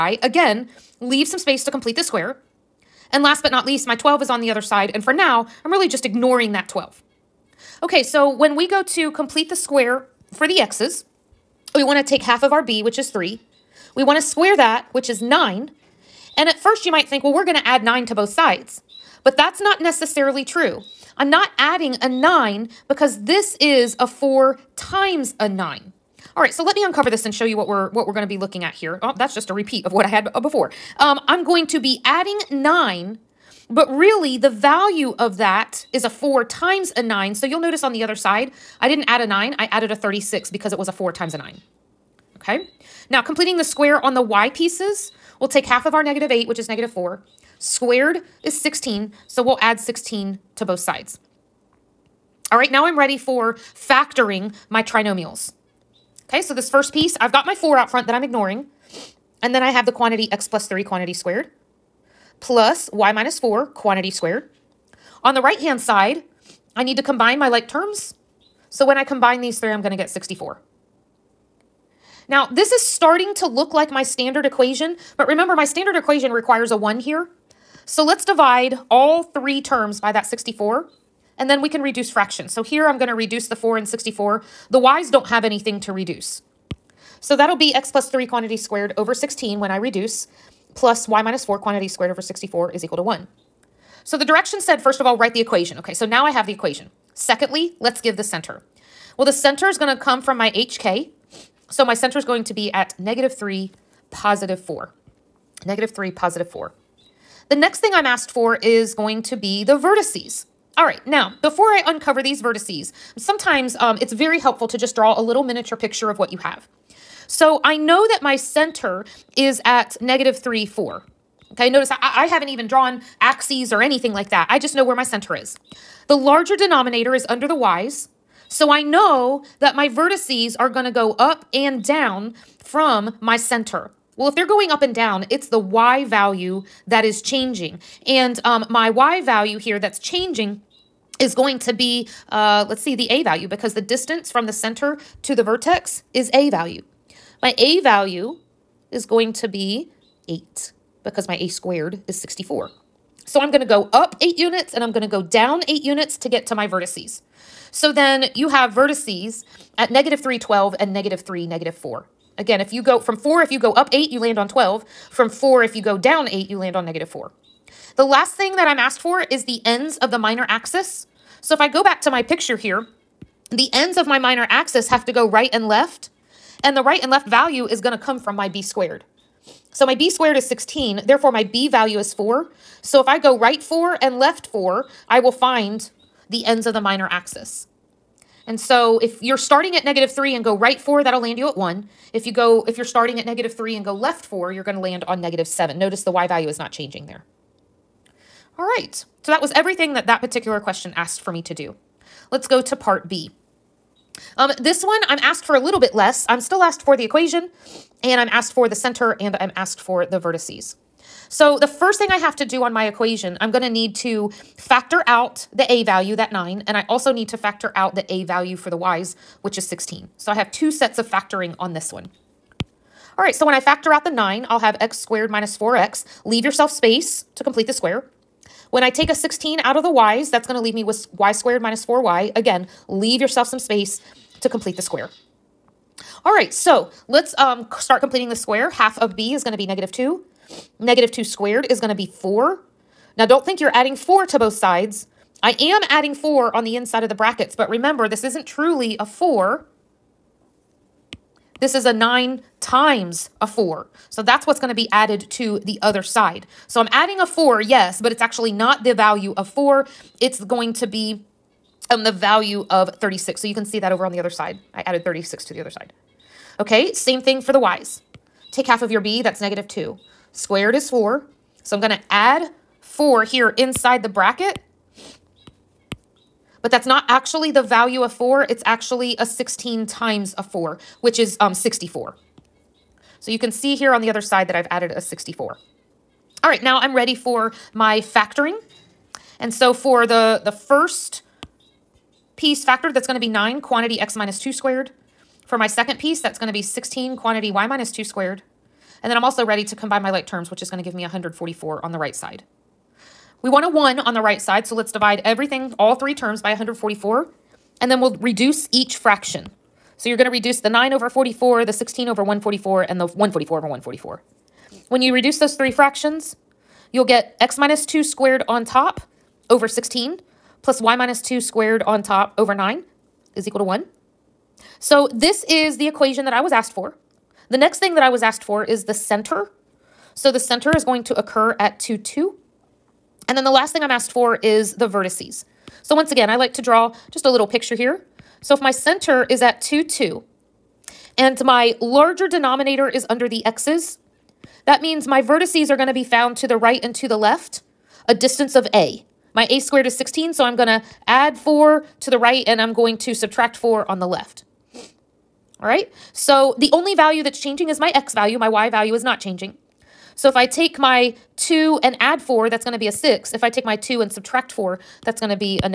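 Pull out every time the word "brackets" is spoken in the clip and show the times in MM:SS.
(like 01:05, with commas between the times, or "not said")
04:07, 04:34.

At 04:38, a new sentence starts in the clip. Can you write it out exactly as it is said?
It's actually a 16 times a 4, which is um, 64.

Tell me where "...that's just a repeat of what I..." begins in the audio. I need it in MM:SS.
00:29.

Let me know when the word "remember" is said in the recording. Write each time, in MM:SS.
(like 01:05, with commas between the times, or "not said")
01:15, 04:07.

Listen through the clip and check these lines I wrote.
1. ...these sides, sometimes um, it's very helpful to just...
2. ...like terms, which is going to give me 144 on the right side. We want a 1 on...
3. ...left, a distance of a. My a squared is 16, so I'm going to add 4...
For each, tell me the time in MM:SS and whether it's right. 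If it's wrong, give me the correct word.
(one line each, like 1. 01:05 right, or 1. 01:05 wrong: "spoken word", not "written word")
1. 01:52 wrong: "vertices", not "sides"
2. 05:00 right
3. 05:47 right.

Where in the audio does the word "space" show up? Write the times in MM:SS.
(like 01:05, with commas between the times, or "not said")
00:01, 03:46, 03:53.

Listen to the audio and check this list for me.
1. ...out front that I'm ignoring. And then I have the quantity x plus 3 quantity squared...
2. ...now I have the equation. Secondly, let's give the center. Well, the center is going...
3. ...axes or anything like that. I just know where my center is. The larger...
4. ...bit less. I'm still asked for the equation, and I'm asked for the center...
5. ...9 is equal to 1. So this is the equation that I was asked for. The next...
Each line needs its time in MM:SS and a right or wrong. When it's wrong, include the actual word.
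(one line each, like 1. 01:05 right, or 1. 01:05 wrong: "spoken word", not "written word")
1. 00:57 right
2. 01:36 right
3. 02:03 right
4. 03:25 right
5. 05:22 right.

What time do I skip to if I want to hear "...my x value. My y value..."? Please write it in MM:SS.
05:57.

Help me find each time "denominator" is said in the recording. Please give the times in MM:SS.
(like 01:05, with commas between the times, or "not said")
02:06, 05:42.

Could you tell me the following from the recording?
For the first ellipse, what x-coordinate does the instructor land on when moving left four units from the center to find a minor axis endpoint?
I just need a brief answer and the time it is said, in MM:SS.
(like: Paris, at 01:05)
-7, at 03:15.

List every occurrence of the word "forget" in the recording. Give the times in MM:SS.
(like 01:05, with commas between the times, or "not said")
not said.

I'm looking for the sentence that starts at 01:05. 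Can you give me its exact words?
On the right-hand side, I need to combine my like terms.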